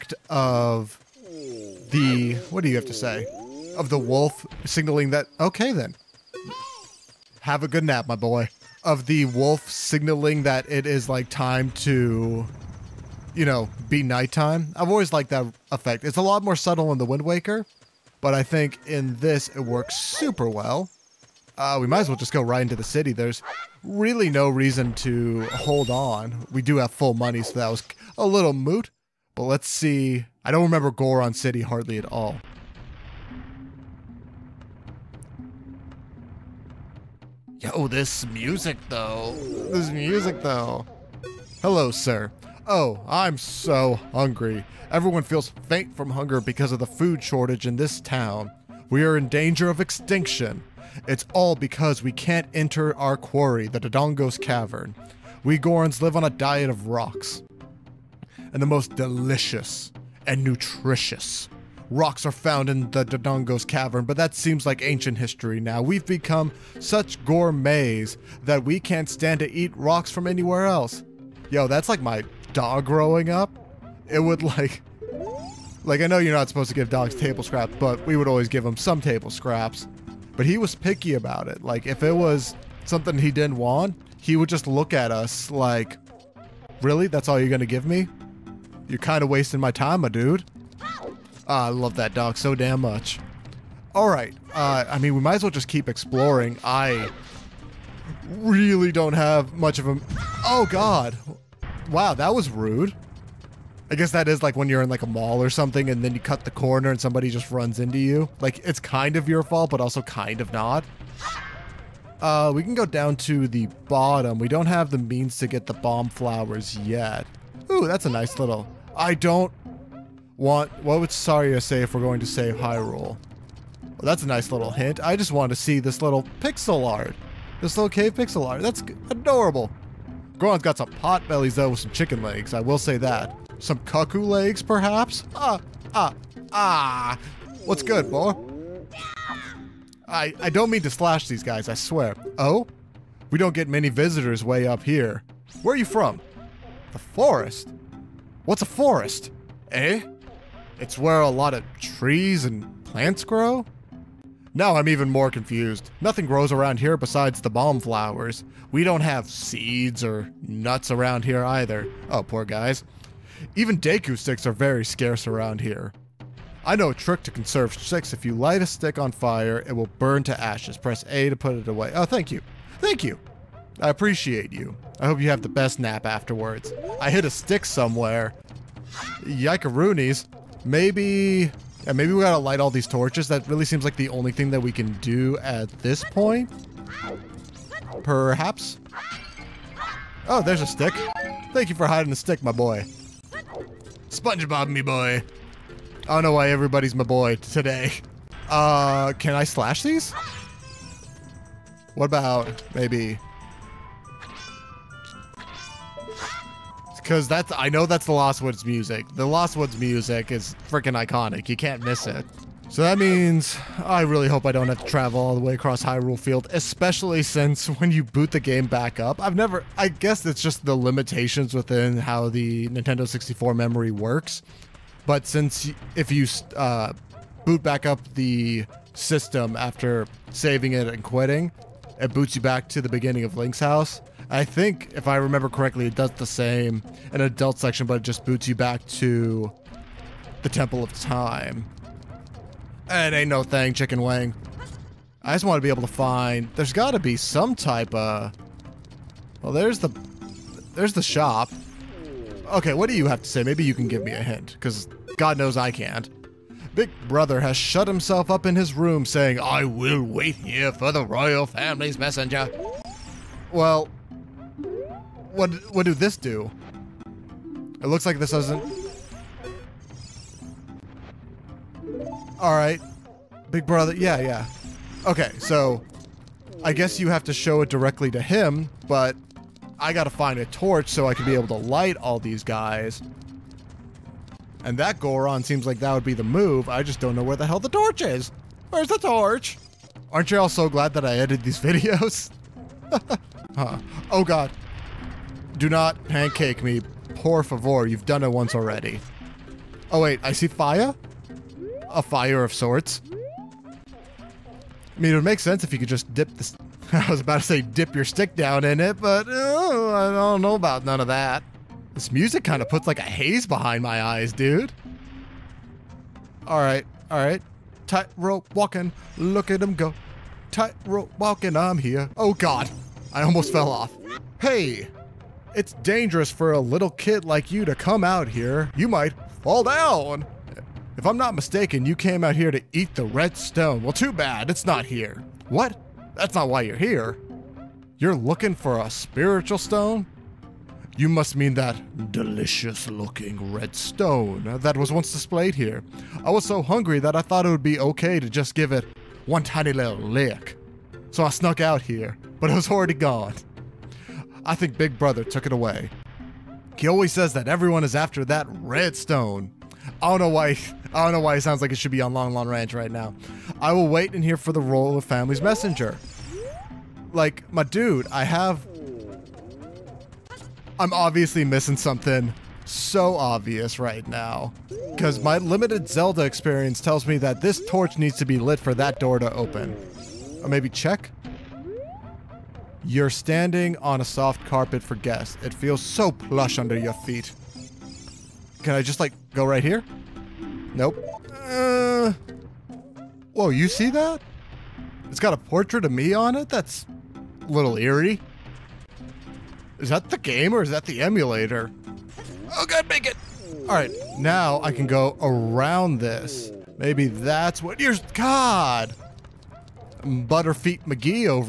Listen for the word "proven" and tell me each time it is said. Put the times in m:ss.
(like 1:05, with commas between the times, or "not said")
not said.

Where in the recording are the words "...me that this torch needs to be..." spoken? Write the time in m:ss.
6:17.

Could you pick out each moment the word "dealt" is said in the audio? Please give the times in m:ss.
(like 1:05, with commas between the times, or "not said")
not said.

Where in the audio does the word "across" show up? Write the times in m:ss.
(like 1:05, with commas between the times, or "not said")
3:35.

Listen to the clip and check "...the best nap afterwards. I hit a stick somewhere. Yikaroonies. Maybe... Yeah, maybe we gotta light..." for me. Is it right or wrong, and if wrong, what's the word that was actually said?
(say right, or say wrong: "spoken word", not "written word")
right.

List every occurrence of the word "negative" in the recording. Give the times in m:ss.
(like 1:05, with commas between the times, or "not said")
not said.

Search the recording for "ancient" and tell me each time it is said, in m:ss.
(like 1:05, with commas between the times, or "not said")
1:04.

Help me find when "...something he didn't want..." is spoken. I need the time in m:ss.
1:22.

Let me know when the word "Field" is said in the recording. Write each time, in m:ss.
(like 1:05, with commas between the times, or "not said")
3:36.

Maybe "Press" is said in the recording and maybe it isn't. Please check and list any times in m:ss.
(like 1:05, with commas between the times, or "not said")
2:50.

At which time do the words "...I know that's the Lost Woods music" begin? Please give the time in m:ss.
3:27.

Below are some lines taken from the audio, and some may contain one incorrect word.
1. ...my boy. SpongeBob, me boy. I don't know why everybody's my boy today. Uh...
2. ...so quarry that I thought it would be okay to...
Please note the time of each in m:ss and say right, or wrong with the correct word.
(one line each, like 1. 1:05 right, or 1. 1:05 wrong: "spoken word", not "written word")
1. 3:12 right
2. 5:46 wrong: "hungry", not "quarry".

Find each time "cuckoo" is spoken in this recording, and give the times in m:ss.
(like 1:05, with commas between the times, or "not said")
2:13.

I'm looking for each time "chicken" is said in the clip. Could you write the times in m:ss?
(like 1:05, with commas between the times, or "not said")
2:11, 4:03.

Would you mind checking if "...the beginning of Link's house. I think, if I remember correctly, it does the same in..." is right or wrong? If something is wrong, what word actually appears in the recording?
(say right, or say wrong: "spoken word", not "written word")
right.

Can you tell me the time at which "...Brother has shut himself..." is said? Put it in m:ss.
4:17.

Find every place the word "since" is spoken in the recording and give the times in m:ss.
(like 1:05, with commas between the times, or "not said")
3:37, 3:45.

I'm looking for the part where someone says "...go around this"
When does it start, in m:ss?
6:44.